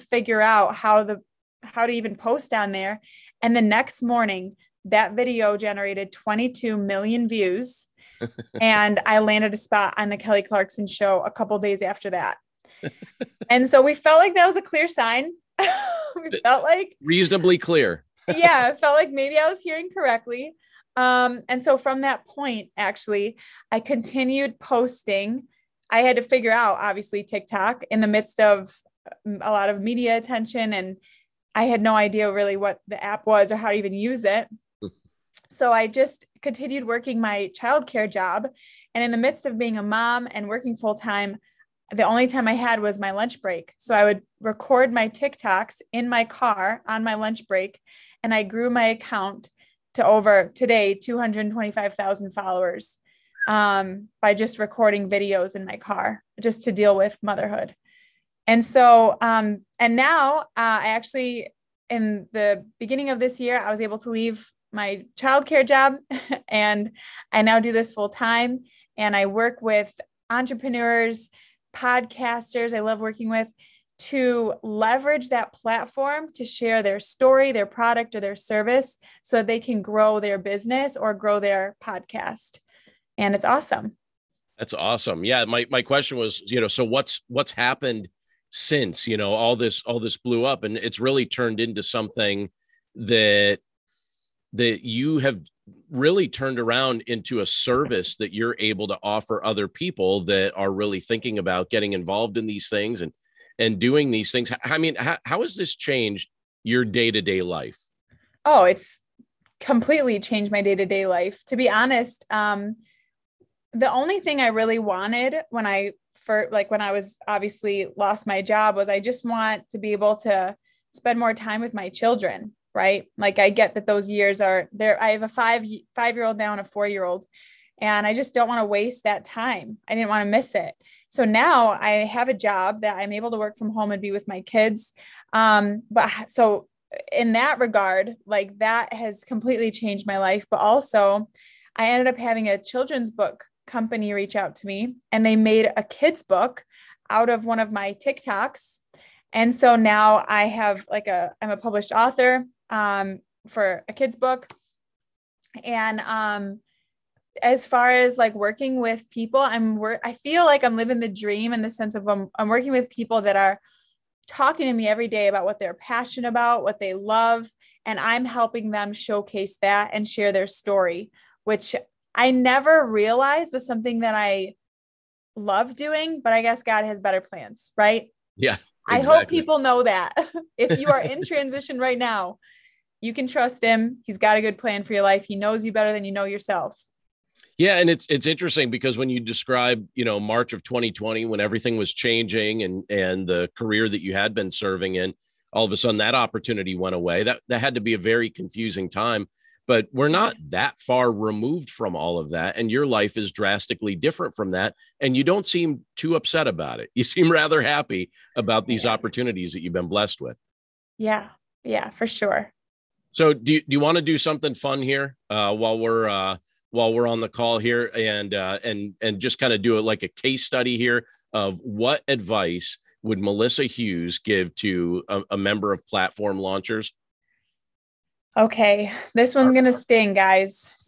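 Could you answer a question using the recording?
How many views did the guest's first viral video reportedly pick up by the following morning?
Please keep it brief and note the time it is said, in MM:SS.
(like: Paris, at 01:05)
22 million, at 00:06.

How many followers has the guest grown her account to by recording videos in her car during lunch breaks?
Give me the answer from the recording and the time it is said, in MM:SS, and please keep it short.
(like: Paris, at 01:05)
225,000, at 00:50.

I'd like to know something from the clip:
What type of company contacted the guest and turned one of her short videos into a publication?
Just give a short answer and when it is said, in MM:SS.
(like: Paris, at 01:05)
Children's book company, at 02:22.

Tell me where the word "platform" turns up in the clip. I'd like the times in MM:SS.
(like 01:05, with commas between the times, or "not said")
01:15, 03:45.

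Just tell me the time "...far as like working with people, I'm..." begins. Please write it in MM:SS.
02:37.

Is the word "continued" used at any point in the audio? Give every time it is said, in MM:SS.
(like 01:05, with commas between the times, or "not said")
00:23, 00:36.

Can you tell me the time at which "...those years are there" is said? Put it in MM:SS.
02:03.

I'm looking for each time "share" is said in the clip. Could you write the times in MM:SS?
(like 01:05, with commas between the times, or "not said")
01:16, 02:50.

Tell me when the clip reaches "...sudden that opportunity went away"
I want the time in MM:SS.
03:15.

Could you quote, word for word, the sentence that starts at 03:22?
And your life is drastically different from that.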